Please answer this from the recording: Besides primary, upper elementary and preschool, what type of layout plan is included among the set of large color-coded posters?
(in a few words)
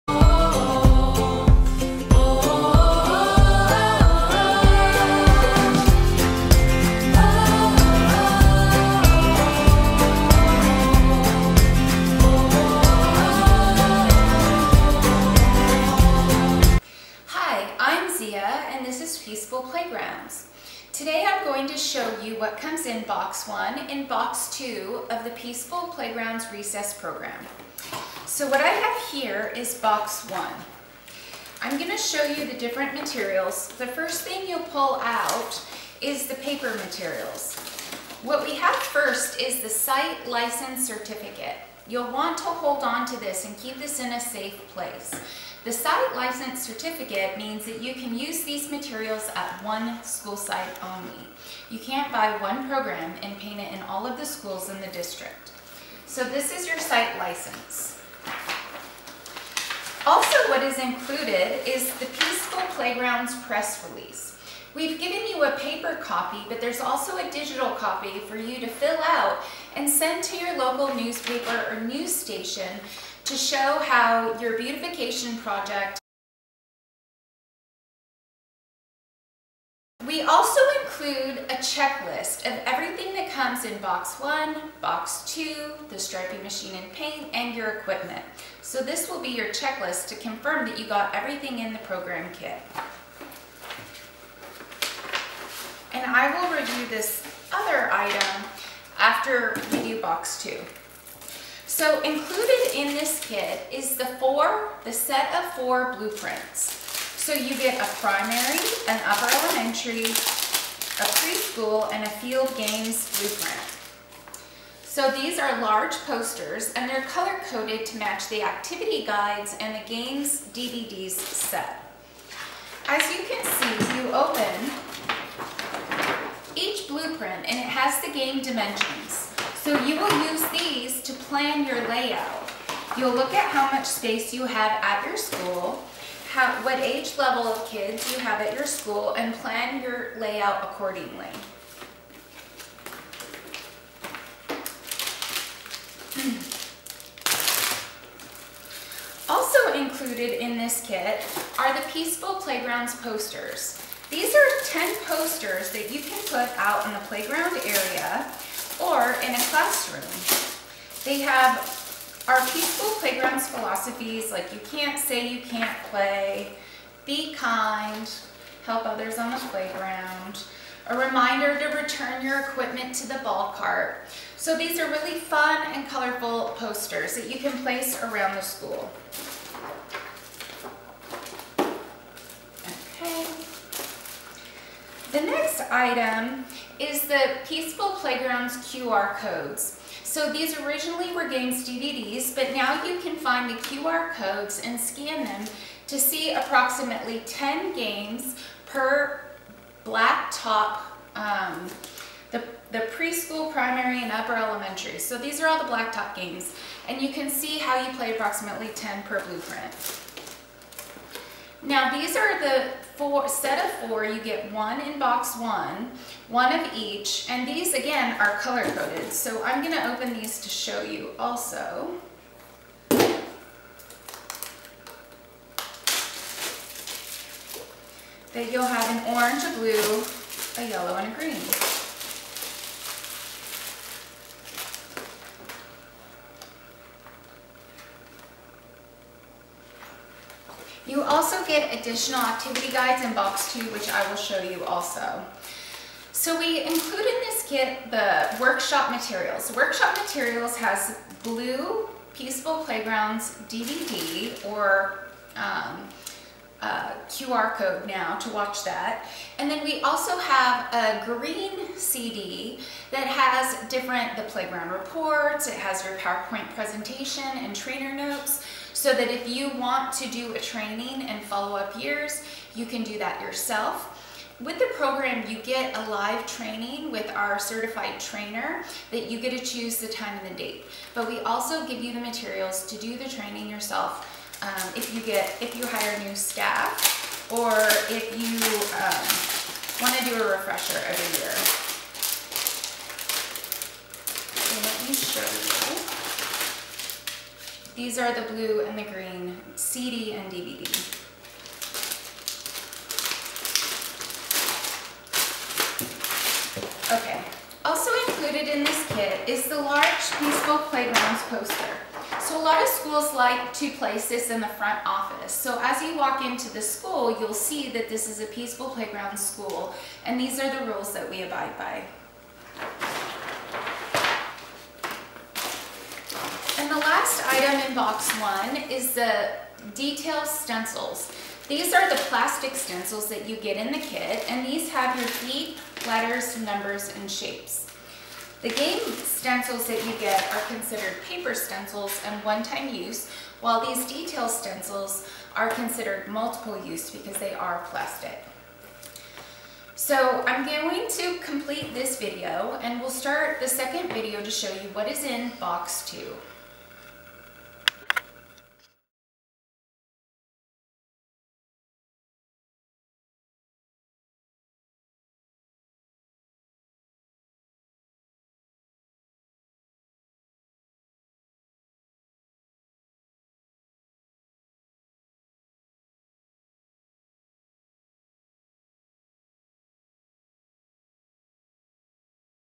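Field games.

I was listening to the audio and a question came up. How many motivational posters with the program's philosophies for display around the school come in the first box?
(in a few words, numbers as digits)
10.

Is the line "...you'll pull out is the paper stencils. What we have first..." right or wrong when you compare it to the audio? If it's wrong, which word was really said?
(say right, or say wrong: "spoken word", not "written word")
wrong: "materials", not "stencils".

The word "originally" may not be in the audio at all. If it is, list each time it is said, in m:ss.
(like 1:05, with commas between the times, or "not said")
3:10.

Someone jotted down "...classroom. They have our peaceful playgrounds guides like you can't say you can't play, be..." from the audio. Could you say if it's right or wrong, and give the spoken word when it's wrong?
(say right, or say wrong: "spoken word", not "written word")
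wrong: "philosophies", not "guides".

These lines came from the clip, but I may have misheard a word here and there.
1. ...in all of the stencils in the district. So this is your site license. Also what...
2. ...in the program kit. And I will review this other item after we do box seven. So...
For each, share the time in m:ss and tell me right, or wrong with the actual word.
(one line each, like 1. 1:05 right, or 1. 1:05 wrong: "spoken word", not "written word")
1. 0:53 wrong: "schools", not "stencils"
2. 1:31 wrong: "two", not "seven".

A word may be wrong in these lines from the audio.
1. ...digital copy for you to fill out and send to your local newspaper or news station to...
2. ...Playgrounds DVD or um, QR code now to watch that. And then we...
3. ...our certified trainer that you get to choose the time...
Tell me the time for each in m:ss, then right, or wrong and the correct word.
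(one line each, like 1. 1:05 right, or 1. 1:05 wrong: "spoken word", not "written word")
1. 1:07 right
2. 4:12 right
3. 4:37 right.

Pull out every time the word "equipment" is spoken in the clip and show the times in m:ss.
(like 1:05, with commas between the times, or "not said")
1:27, 2:52.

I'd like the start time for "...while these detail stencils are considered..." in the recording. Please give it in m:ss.
5:43.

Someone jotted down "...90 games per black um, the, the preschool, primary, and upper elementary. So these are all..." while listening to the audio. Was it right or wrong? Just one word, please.
wrong.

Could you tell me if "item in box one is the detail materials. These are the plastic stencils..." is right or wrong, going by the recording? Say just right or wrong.
wrong.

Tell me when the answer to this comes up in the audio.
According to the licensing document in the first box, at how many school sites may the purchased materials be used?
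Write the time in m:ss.
0:49.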